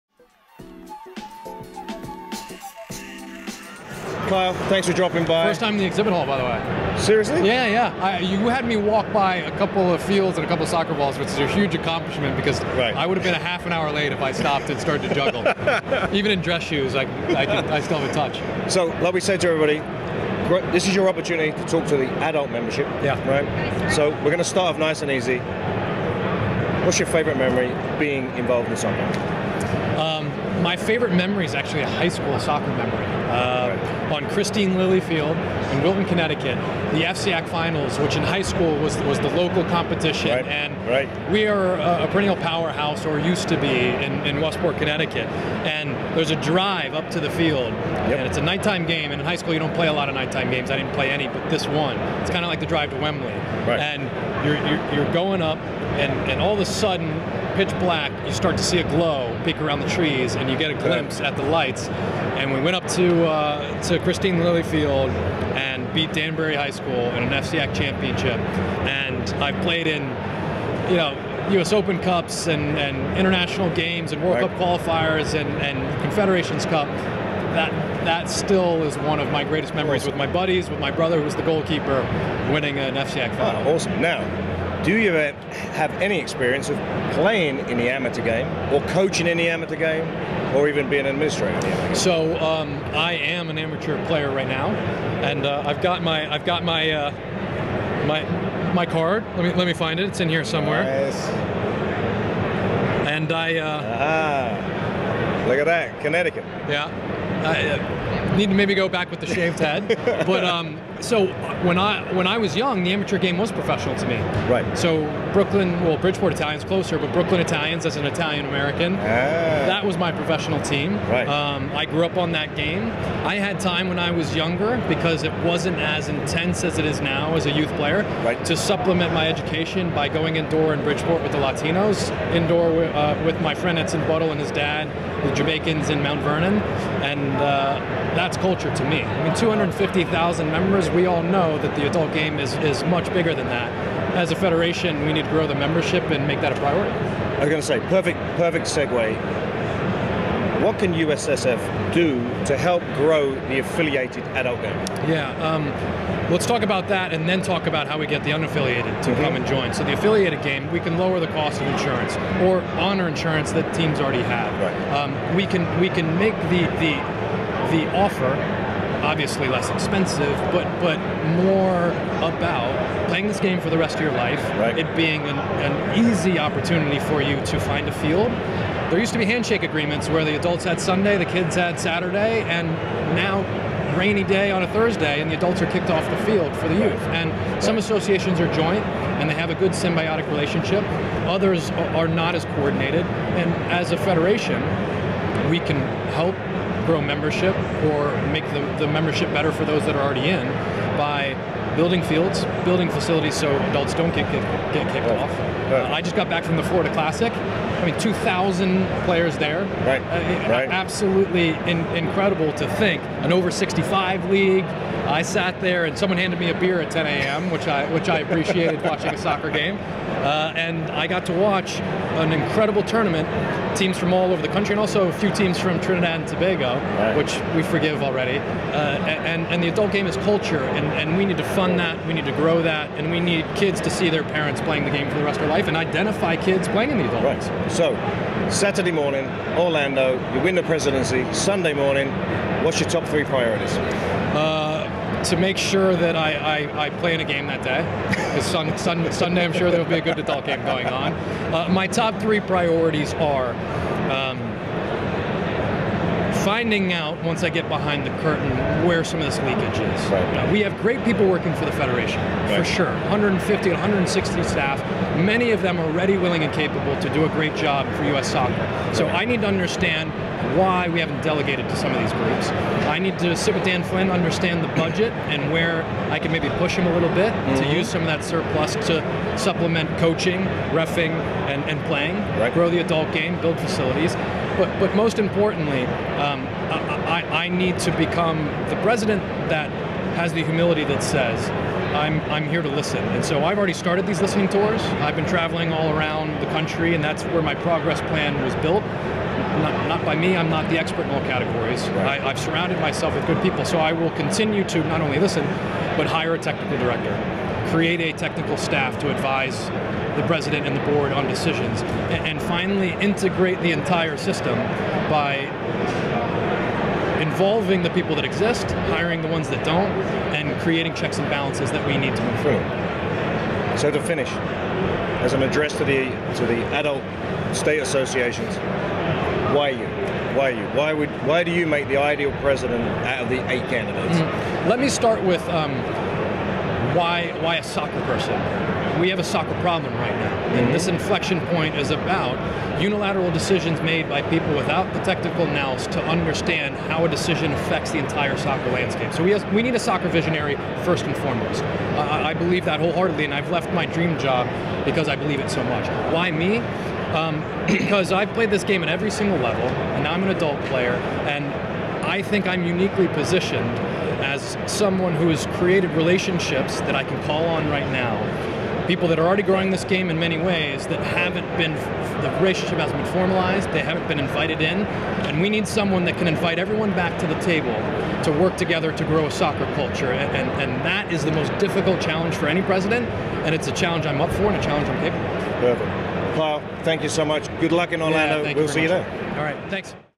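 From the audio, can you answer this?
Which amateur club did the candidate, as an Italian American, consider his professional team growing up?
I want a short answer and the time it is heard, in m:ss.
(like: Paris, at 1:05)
Brooklyn Italians, at 1:57.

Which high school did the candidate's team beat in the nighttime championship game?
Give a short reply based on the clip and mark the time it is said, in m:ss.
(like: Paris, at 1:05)
Danbury High School, at 1:06.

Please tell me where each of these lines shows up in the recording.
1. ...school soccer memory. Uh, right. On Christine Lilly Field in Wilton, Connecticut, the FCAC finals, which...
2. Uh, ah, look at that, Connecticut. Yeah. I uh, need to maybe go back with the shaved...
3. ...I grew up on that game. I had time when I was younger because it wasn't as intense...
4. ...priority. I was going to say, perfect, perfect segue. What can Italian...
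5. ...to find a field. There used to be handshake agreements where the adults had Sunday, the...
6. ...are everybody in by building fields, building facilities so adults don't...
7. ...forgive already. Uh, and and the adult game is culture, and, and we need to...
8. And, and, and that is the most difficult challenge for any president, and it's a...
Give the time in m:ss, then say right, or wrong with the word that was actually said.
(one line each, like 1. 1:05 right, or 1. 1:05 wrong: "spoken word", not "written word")
1. 0:32 right
2. 1:43 right
3. 2:01 right
4. 2:26 wrong: "USSF", not "Italian"
5. 2:57 right
6. 3:19 wrong: "already", not "everybody"
7. 3:47 right
8. 6:20 right.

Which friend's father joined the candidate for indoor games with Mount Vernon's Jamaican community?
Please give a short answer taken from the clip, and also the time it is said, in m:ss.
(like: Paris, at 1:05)
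Edson Buddle, at 2:13.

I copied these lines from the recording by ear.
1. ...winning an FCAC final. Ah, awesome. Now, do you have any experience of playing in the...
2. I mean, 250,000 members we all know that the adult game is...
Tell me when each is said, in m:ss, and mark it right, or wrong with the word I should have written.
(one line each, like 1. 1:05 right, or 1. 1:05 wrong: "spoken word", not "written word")
1. 1:22 right
2. 2:19 right.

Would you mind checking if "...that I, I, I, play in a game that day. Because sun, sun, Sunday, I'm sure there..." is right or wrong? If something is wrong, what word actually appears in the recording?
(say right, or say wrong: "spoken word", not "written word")
right.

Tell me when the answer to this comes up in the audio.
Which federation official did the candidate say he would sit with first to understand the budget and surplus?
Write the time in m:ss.
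4:33.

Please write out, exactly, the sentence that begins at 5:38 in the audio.
We have a soccer problem right now, mm-hmm.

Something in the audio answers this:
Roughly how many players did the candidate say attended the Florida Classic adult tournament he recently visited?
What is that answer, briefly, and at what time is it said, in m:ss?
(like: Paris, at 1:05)
2,000, at 3:27.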